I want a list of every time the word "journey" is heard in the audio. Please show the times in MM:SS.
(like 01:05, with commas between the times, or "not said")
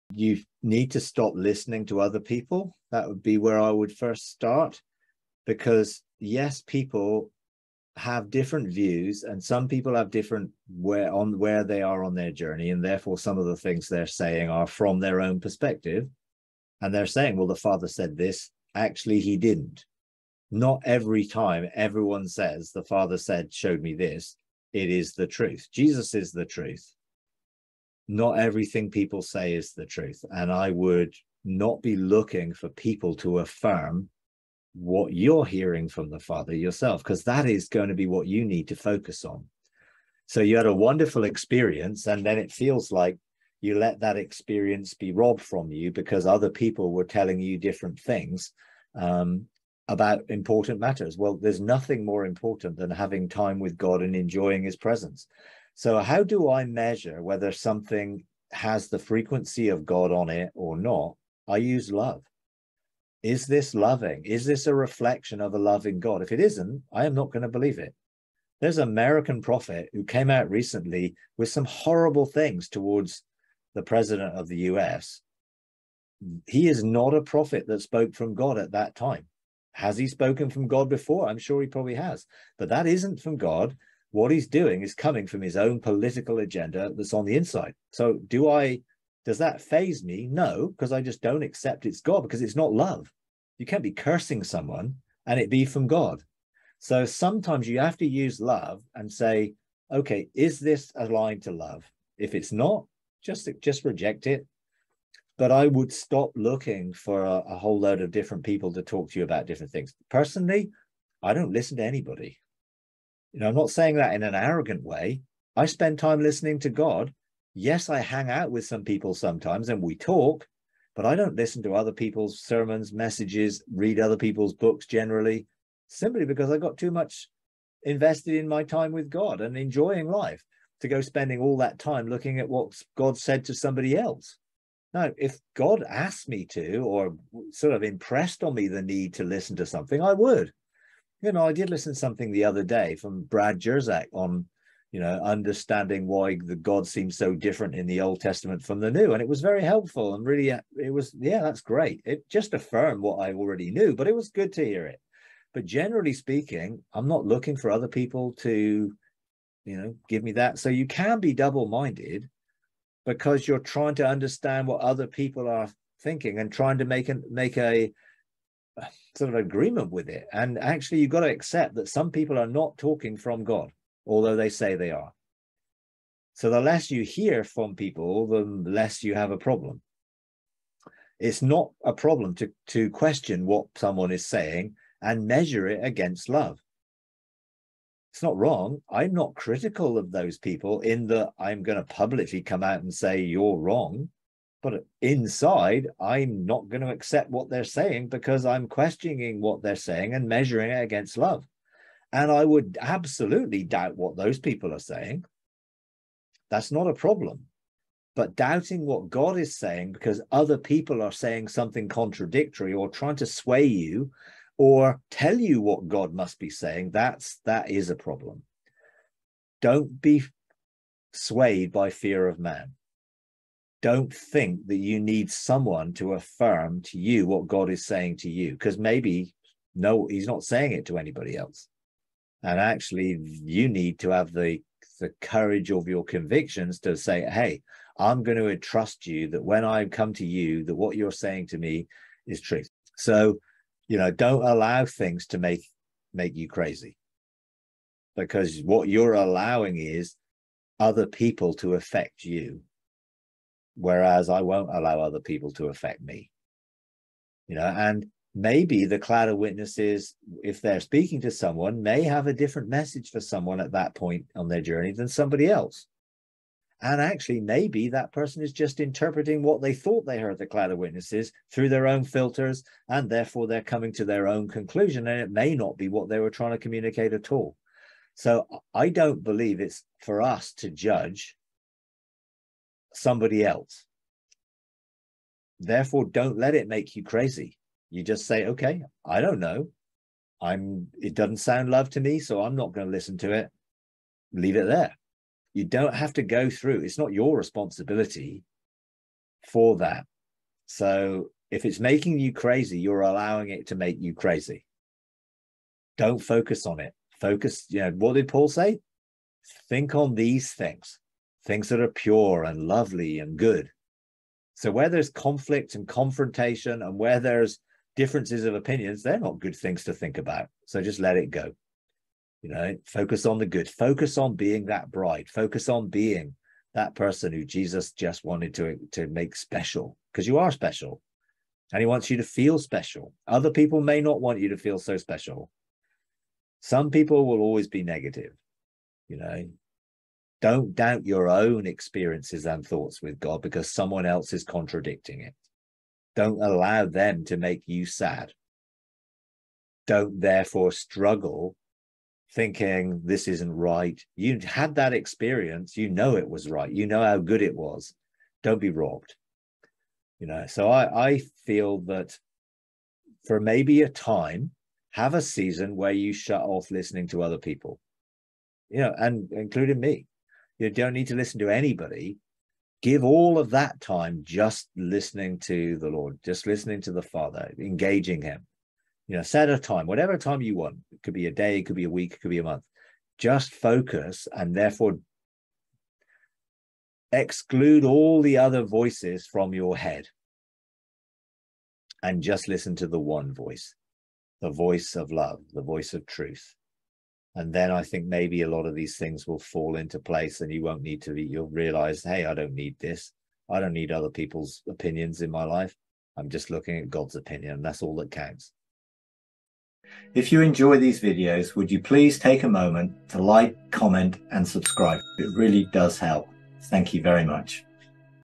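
00:12, 04:24.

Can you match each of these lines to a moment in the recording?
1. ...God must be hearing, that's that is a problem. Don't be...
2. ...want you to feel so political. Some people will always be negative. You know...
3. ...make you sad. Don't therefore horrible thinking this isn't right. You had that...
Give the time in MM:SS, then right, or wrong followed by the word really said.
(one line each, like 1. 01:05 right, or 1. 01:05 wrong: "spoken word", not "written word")
1. 03:35 wrong: "saying", not "hearing"
2. 05:34 wrong: "special", not "political"
3. 05:47 wrong: "struggle", not "horrible".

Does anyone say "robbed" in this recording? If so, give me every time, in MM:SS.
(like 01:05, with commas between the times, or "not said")
00:45, 05:58.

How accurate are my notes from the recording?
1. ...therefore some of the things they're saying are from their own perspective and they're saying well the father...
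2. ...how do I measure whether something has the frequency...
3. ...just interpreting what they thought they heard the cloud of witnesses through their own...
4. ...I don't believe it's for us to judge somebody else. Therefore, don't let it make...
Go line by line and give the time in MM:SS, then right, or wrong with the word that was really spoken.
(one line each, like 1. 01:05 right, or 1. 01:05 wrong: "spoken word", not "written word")
1. 00:12 right
2. 00:55 right
3. 04:28 right
4. 04:38 right.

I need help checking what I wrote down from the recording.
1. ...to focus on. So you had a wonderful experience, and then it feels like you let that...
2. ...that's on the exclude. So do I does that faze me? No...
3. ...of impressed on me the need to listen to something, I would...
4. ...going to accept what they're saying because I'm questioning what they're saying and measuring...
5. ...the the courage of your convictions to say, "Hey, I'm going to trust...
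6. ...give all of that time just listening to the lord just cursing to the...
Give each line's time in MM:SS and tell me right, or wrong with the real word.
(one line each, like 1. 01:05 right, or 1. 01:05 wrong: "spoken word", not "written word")
1. 00:38 right
2. 01:26 wrong: "inside", not "exclude"
3. 02:17 right
4. 03:16 right
5. 03:54 right
6. 06:12 wrong: "listening", not "cursing".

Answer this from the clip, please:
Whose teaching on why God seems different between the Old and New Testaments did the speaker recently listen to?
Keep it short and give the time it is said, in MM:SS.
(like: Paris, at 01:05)
Brad Jersak, at 02:23.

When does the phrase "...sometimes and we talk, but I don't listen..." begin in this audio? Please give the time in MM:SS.
01:59.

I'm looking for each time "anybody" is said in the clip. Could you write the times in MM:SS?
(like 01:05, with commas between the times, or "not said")
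01:51, 03:50, 06:11.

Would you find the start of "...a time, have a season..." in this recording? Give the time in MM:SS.
06:03.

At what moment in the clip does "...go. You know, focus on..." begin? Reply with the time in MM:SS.
05:21.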